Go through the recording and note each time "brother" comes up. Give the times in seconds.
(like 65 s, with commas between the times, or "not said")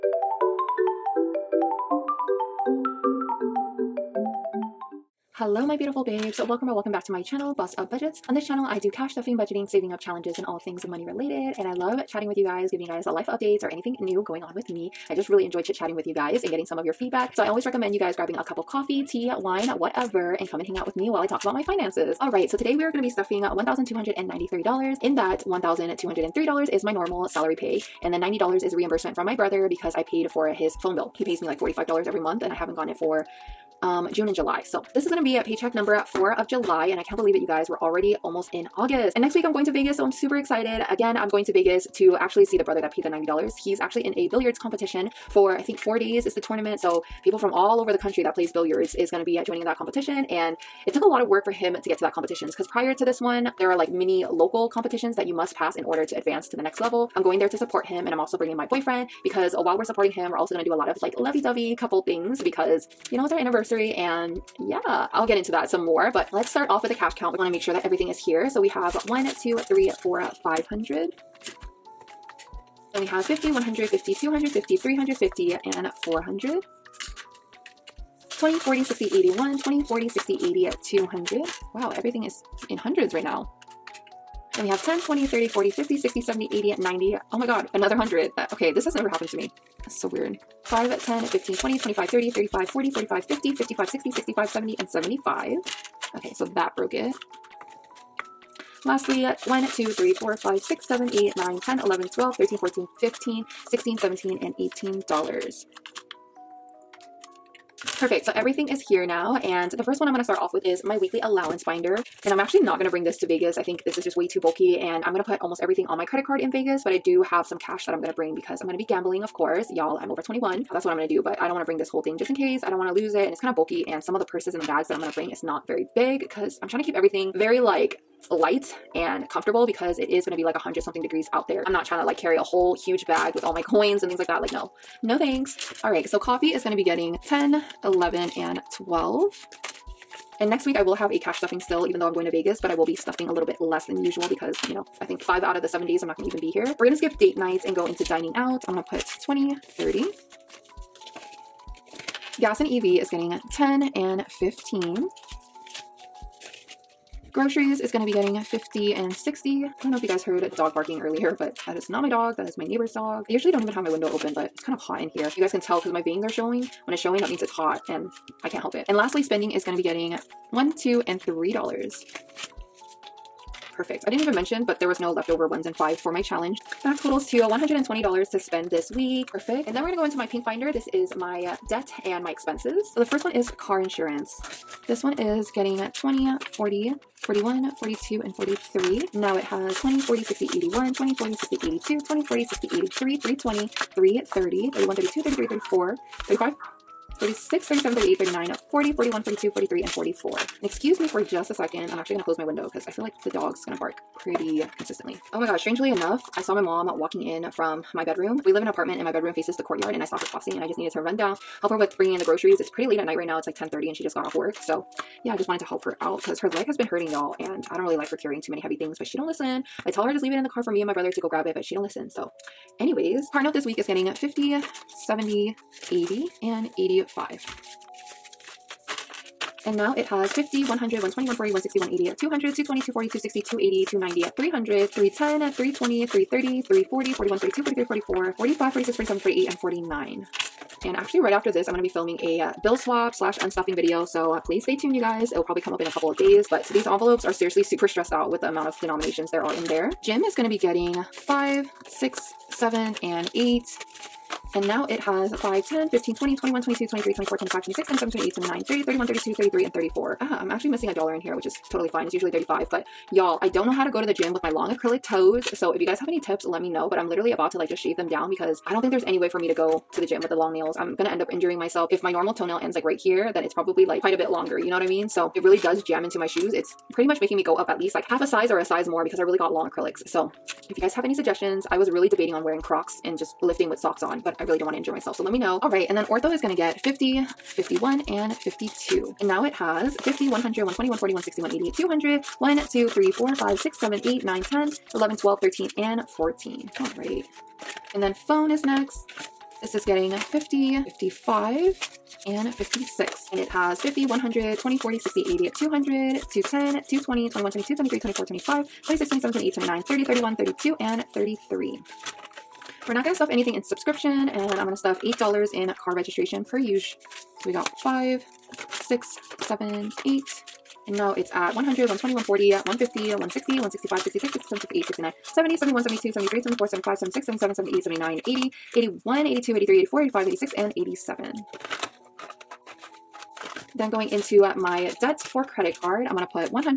29 s, 42 s, 220 s.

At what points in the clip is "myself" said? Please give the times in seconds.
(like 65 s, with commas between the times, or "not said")
271 s, 284 s.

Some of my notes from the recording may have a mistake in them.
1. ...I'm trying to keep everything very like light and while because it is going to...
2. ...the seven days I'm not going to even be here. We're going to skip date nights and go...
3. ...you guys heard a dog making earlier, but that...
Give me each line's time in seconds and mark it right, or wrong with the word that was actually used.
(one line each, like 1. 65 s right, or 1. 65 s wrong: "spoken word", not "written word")
1. 126 s wrong: "comfortable", not "while"
2. 145 s right
3. 160 s wrong: "barking", not "making".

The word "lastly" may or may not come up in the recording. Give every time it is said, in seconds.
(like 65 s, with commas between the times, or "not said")
98 s, 168 s.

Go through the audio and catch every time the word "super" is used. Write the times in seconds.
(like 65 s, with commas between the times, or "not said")
40 s, 247 s.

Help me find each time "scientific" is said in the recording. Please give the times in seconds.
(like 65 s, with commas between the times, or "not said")
not said.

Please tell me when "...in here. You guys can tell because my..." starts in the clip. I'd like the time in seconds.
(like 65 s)
164 s.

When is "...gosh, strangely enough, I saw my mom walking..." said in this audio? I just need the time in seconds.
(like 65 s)
205 s.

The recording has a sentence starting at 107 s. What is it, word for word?
Perfect, so everything is here now, and the first one I'm gonna start off with is my weekly allowance binder.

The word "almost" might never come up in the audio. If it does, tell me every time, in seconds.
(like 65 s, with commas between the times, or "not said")
38 s, 115 s.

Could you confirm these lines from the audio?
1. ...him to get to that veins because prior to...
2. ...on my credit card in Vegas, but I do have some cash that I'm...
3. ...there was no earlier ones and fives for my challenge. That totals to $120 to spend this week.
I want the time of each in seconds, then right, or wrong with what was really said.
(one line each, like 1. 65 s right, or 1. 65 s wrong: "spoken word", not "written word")
1. 51 s wrong: "competitions", not "veins"
2. 115 s right
3. 174 s wrong: "leftover", not "earlier".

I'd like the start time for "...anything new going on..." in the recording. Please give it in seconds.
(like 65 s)
13 s.